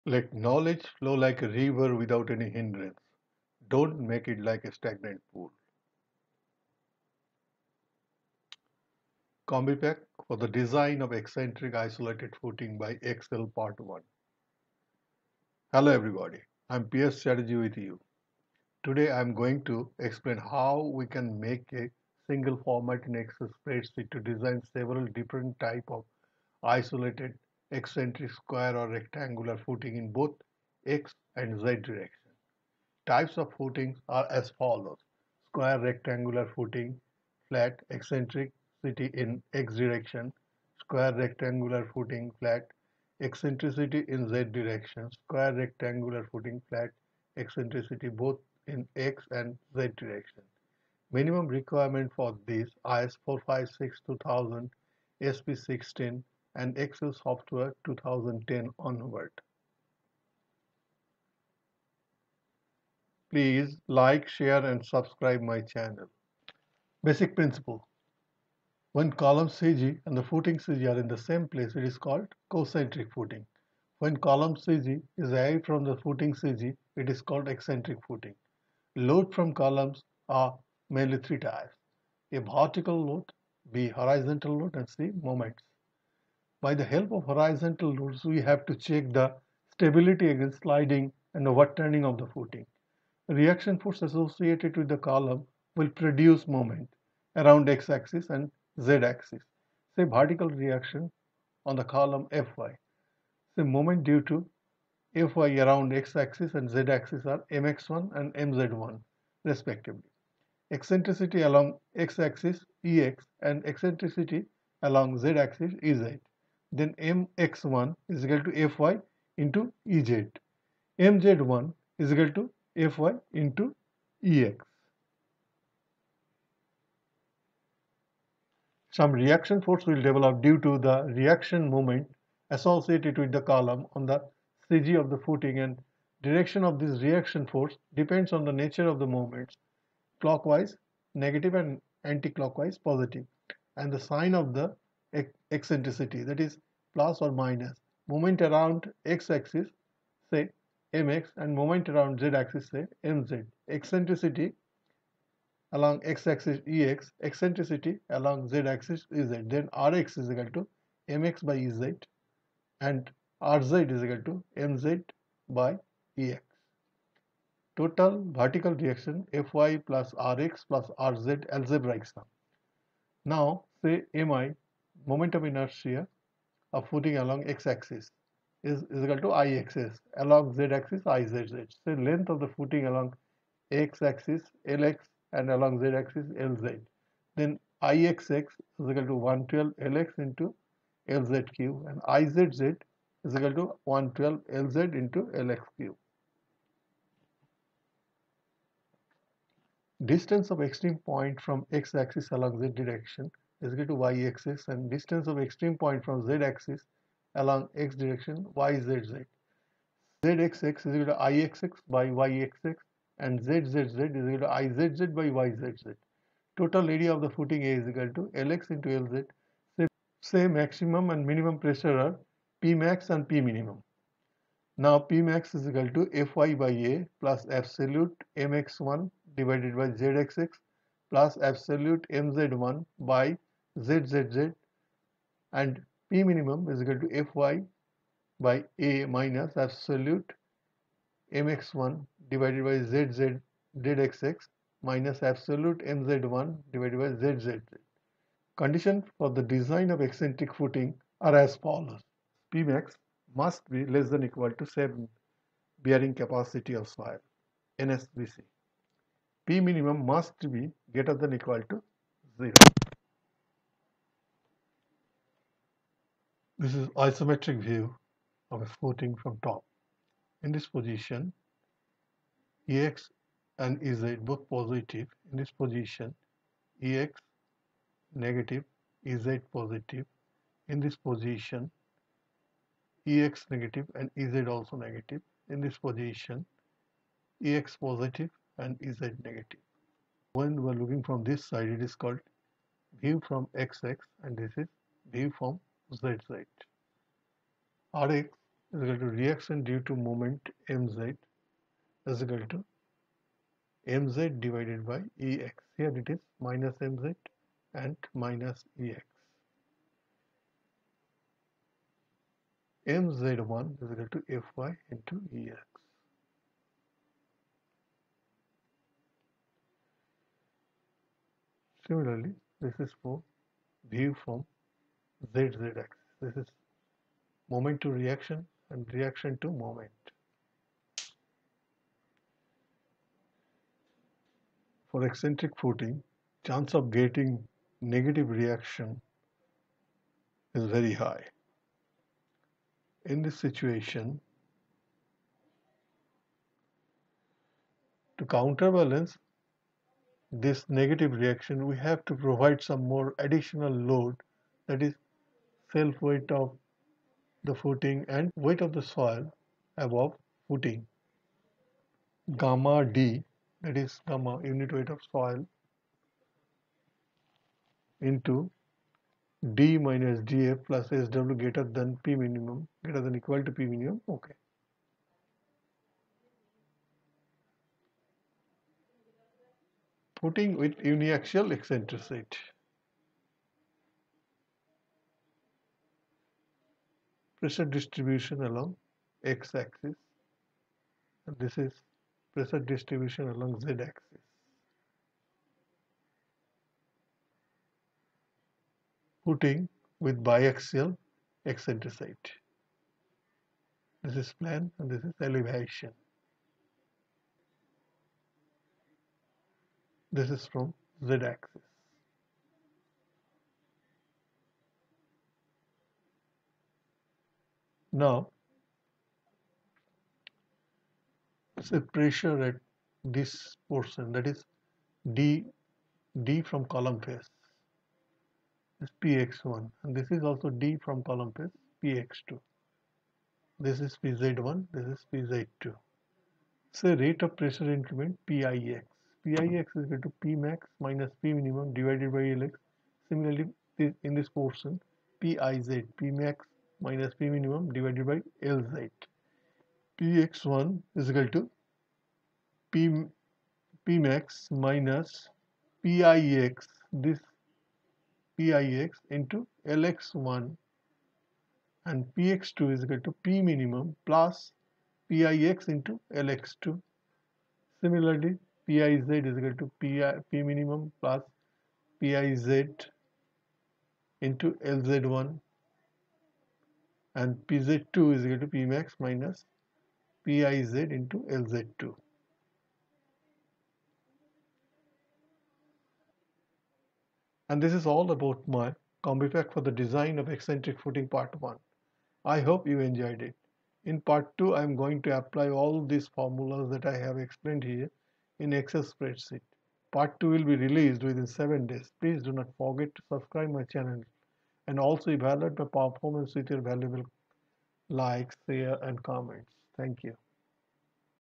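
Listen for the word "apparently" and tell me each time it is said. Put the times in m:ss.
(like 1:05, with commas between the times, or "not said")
not said.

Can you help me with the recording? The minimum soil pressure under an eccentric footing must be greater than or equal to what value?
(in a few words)
0.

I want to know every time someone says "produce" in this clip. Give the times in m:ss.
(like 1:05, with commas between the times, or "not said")
1:35.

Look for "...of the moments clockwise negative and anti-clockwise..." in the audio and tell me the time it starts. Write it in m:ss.
2:18.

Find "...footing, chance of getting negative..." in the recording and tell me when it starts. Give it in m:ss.
5:35.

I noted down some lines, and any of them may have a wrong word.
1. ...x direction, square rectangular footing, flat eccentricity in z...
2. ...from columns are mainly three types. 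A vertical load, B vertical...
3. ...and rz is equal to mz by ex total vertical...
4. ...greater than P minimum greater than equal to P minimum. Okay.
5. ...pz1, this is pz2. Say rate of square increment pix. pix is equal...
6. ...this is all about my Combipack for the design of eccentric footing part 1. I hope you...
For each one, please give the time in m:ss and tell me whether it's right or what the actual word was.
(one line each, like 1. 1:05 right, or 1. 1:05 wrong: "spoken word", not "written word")
1. 0:39 right
2. 1:19 wrong: "horizontal", not "vertical"
3. 2:42 right
4. 6:11 right
5. 7:14 wrong: "pressure", not "square"
6. 8:07 right.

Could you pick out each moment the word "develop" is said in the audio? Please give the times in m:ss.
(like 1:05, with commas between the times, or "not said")
2:10.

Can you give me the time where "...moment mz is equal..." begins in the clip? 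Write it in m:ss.
4:59.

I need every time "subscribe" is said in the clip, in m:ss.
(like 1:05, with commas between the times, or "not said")
1:04, 8:23.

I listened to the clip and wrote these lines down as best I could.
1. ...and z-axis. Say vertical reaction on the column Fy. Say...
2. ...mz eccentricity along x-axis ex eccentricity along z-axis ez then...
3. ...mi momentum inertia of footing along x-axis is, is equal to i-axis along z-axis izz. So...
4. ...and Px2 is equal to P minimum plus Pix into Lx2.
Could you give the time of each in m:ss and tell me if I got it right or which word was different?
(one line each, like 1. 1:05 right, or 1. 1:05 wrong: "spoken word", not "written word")
1. 1:38 right
2. 2:33 right
3. 2:54 right
4. 7:41 right.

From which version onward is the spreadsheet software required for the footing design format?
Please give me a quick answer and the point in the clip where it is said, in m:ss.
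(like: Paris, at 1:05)
2010, at 0:56.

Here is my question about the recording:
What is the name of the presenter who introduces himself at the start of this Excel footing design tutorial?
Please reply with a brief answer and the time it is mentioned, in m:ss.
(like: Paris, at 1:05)
PS Chatterjee, at 0:16.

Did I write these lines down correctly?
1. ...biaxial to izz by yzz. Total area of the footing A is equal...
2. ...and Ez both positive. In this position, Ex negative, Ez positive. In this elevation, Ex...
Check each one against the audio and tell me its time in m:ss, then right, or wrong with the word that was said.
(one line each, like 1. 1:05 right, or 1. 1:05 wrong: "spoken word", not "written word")
1. 3:34 wrong: "equal", not "biaxial"
2. 4:33 wrong: "position", not "elevation".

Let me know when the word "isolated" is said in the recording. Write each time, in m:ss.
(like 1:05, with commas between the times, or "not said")
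0:11, 0:26.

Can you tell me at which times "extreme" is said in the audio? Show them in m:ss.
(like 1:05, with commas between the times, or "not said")
3:20, 3:25.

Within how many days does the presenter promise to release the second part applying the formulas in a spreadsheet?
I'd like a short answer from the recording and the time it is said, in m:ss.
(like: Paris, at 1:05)
7, at 8:21.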